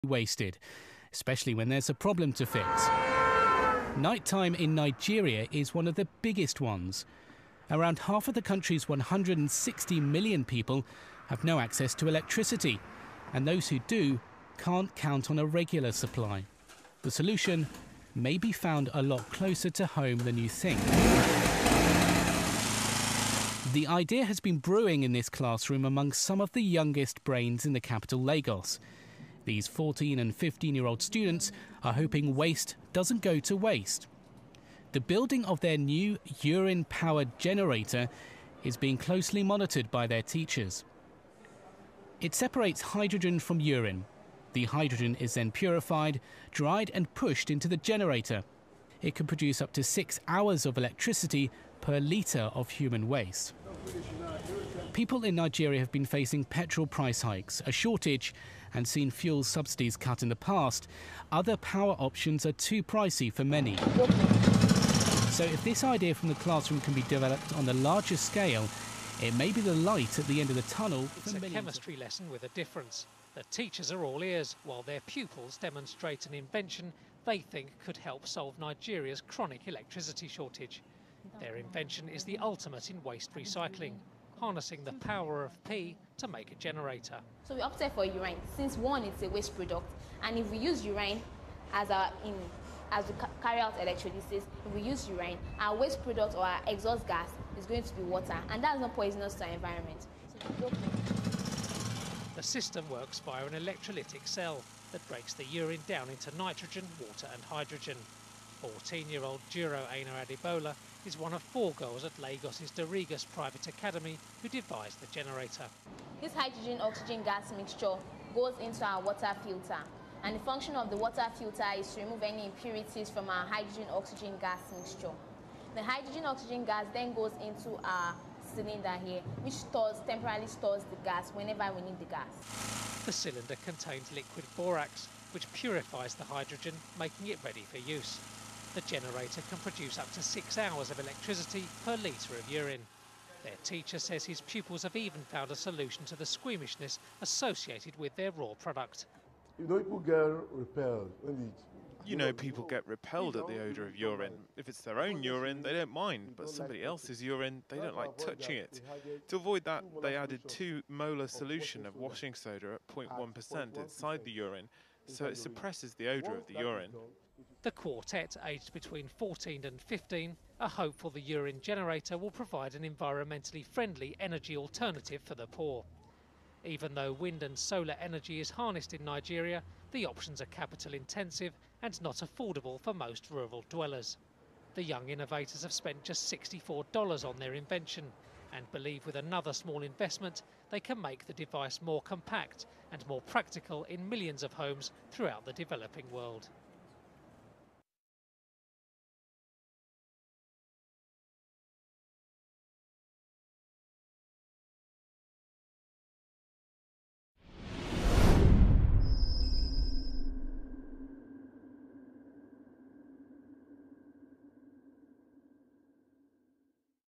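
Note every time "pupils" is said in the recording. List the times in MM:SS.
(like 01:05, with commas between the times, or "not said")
01:15, 02:24.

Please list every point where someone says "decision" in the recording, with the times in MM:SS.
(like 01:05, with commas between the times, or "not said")
not said.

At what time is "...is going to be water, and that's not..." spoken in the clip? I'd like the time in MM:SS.
01:37.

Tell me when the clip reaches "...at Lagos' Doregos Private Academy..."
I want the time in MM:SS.
01:52.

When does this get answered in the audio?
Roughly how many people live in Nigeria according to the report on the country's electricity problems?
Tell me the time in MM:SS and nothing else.
00:08.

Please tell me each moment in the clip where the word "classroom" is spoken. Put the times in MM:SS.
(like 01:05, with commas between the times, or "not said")
00:25, 01:06.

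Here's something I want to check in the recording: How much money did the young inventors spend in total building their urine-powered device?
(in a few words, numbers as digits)
$64.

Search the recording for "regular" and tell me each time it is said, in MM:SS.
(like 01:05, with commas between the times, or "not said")
00:15.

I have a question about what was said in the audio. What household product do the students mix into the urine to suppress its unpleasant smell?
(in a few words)
washing soda.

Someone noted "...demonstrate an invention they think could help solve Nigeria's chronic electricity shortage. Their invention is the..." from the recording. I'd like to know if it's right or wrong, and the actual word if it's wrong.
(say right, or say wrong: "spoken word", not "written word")
right.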